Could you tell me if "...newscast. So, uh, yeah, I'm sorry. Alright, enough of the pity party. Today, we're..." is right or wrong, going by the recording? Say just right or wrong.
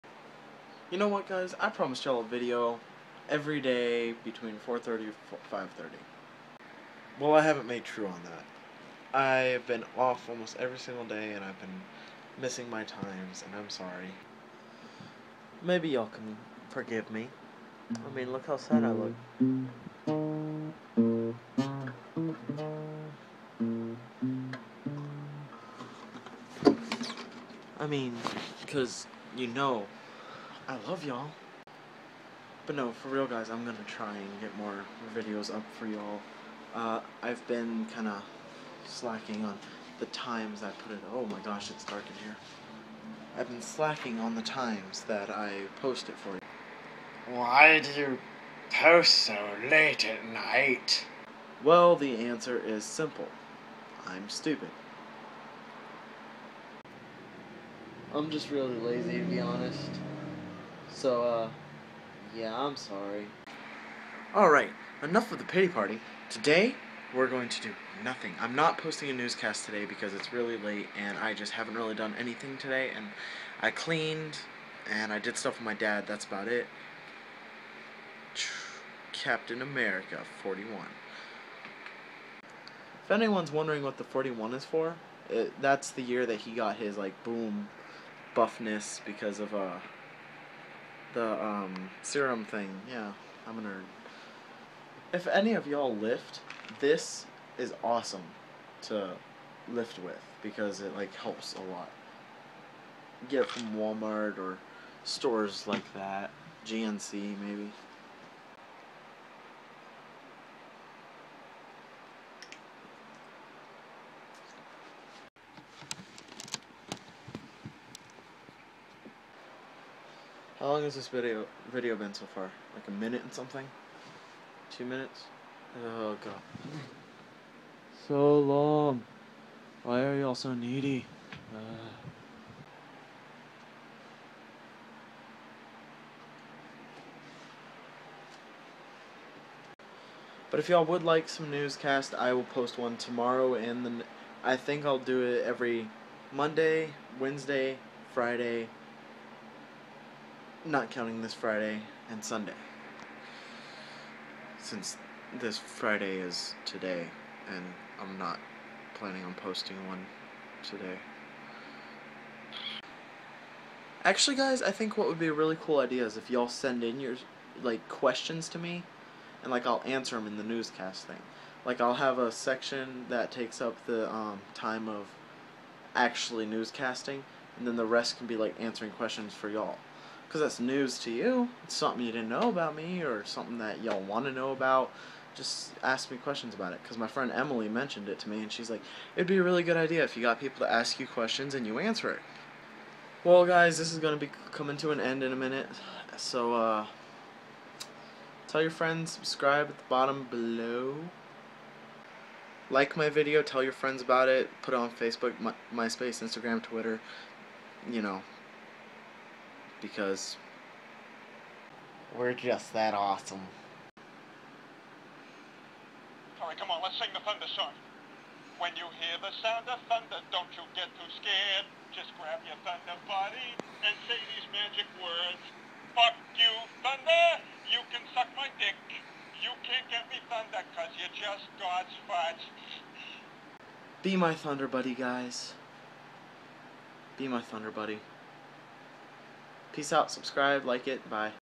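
wrong.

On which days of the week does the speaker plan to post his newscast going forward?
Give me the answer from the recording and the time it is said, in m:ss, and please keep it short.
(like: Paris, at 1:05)
Monday, Wednesday, Friday, at 2:26.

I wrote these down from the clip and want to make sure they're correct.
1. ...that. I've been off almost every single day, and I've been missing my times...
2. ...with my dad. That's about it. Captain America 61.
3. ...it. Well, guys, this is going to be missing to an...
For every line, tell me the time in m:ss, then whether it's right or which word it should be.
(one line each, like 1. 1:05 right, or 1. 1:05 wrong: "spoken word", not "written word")
1. 0:08 right
2. 1:15 wrong: "41", not "61"
3. 3:12 wrong: "coming", not "missing".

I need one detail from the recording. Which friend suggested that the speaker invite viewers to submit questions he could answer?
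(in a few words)
Emily.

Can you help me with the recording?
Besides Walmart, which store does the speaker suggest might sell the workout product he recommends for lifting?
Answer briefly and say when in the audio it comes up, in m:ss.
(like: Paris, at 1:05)
GNC, at 1:46.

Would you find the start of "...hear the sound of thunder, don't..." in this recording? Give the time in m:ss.
3:39.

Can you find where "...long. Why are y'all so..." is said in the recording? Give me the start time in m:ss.
2:08.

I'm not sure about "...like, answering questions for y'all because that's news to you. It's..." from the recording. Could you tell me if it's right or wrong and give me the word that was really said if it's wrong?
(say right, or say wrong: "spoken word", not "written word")
right.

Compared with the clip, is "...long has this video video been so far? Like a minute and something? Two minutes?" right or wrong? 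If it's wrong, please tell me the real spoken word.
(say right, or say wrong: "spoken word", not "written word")
right.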